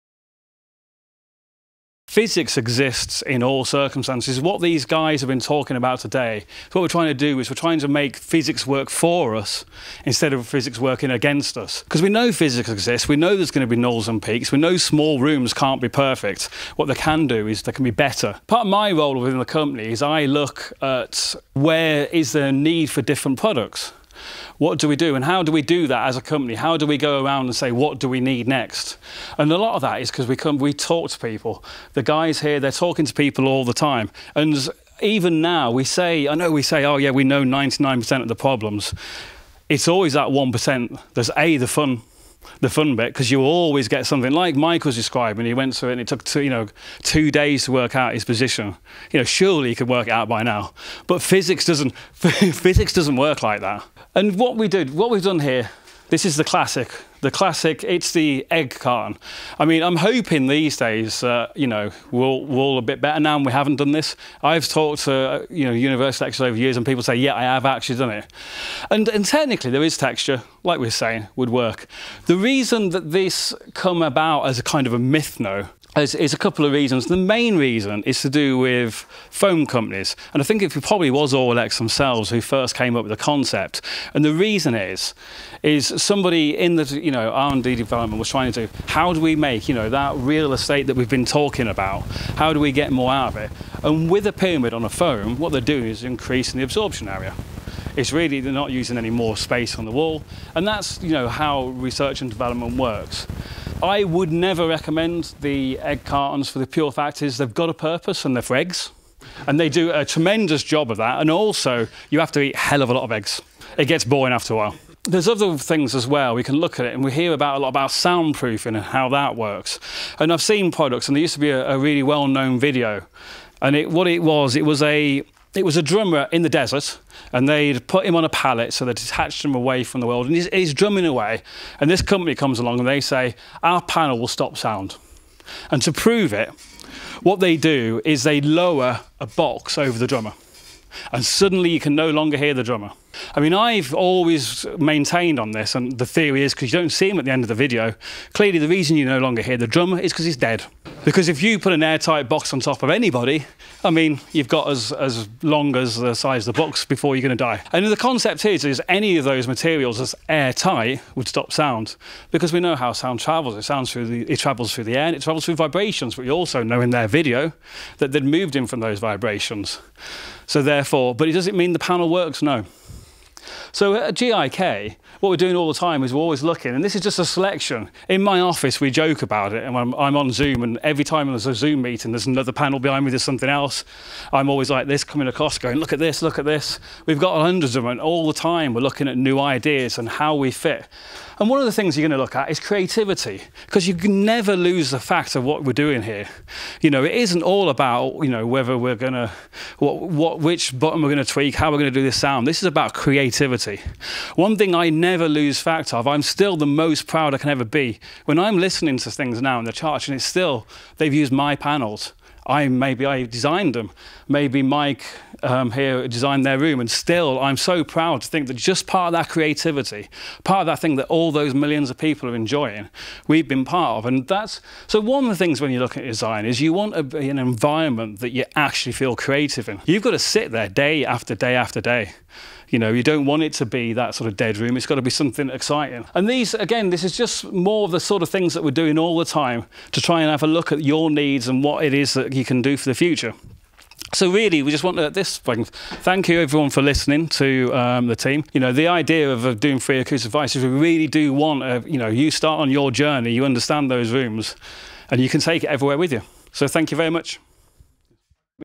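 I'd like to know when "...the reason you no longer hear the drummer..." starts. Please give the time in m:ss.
2:28.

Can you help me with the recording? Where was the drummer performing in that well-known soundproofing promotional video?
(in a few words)
In the desert.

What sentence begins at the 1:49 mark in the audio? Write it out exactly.
And they do a tremendous job of that.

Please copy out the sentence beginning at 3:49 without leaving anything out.
You've got to sit there day after day after day.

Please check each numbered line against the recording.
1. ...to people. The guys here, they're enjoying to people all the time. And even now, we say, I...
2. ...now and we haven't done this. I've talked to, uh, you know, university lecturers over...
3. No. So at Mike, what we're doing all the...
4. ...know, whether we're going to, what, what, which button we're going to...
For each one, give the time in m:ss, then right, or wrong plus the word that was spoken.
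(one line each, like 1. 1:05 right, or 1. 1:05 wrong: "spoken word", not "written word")
1. 0:31 wrong: "talking", not "enjoying"
2. 1:03 right
3. 2:52 wrong: "GIK", not "Mike"
4. 3:18 right.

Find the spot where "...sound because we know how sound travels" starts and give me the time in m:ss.
2:41.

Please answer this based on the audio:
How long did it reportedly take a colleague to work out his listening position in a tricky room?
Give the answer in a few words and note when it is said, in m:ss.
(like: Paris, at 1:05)
2 days, at 0:47.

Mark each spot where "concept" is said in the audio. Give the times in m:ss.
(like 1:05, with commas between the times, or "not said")
1:23, 2:37.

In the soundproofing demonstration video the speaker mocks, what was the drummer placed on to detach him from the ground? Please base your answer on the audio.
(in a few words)
A pallet.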